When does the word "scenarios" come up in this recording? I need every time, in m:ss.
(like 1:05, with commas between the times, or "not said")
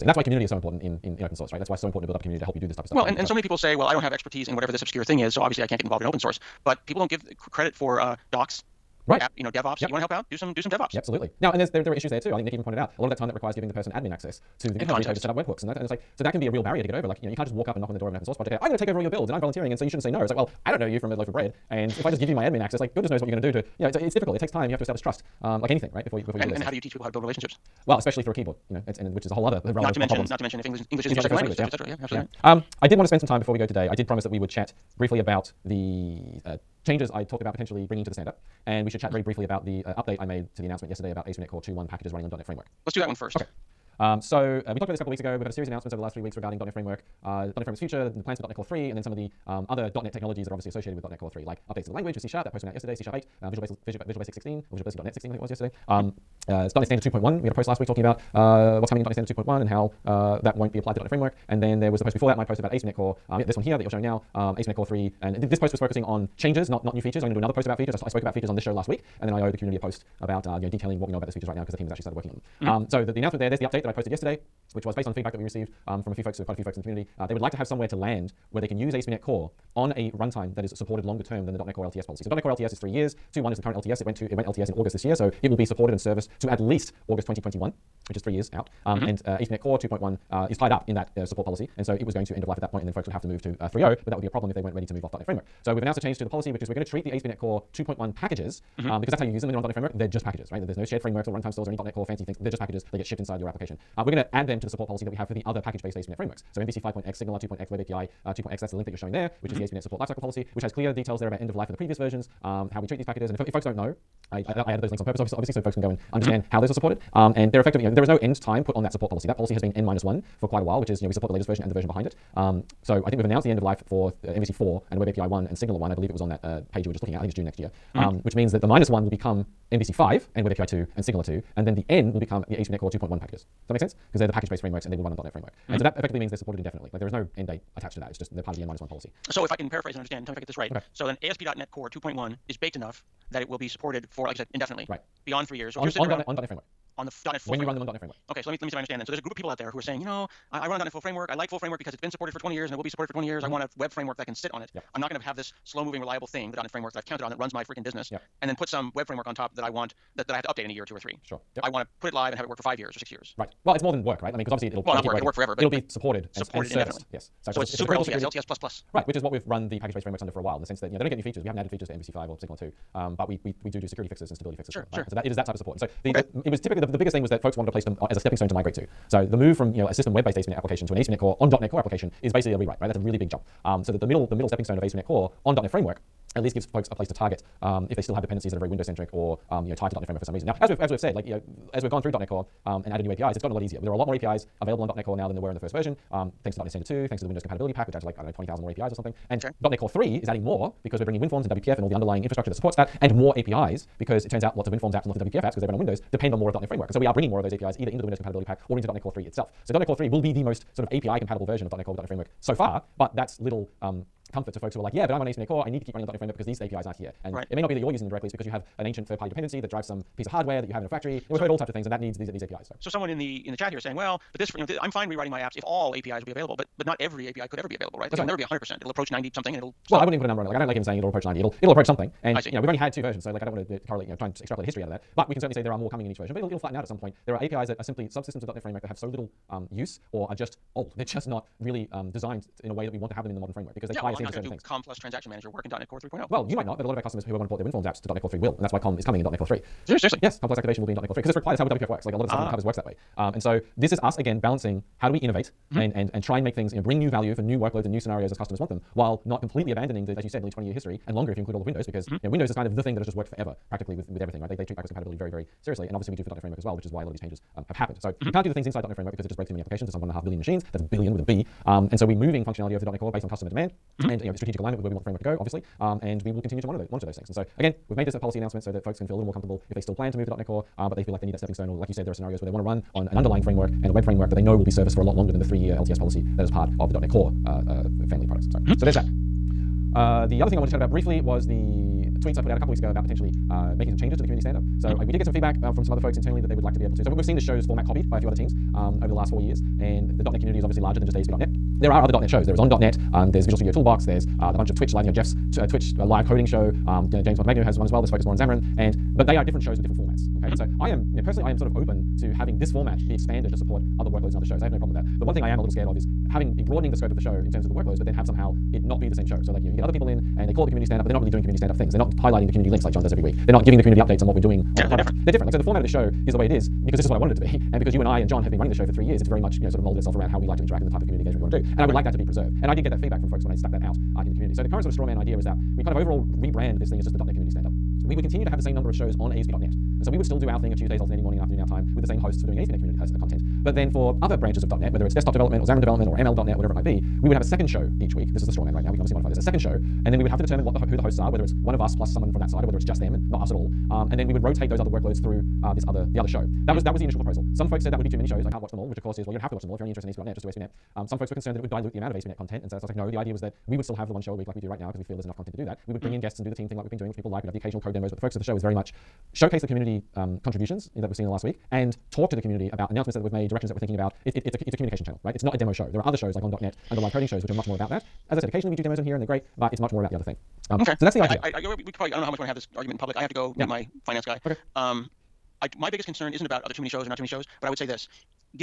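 4:17, 4:42.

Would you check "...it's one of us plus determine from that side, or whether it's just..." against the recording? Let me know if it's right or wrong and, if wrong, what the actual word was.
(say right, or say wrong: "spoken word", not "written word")
wrong: "someone", not "determine".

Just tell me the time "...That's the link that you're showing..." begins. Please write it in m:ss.
1:48.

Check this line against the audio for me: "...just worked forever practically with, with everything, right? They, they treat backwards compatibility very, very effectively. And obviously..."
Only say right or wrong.
wrong.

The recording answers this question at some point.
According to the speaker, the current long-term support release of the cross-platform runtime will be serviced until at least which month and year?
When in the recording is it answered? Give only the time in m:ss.
1:27.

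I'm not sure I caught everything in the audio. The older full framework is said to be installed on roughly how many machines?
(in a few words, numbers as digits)
1.5 billion.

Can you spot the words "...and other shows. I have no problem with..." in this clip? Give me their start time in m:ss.
5:14.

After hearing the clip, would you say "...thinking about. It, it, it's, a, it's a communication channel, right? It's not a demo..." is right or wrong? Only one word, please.
right.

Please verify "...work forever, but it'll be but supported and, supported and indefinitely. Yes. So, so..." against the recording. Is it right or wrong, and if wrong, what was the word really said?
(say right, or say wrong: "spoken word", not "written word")
right.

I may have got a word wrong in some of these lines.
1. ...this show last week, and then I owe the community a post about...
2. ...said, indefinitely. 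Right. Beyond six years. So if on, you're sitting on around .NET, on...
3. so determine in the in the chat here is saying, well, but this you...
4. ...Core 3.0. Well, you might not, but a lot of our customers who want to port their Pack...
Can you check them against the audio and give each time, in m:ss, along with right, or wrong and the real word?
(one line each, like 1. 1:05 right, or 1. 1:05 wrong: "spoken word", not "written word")
1. 1:08 right
2. 2:24 wrong: "three", not "six"
3. 3:42 wrong: "someone", not "determine"
4. 4:05 wrong: "WinForms", not "Pack".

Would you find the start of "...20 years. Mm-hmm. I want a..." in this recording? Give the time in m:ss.
2:33.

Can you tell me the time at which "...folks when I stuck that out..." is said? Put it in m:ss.
5:33.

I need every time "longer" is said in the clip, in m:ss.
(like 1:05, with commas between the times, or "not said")
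1:21, 4:21, 4:45.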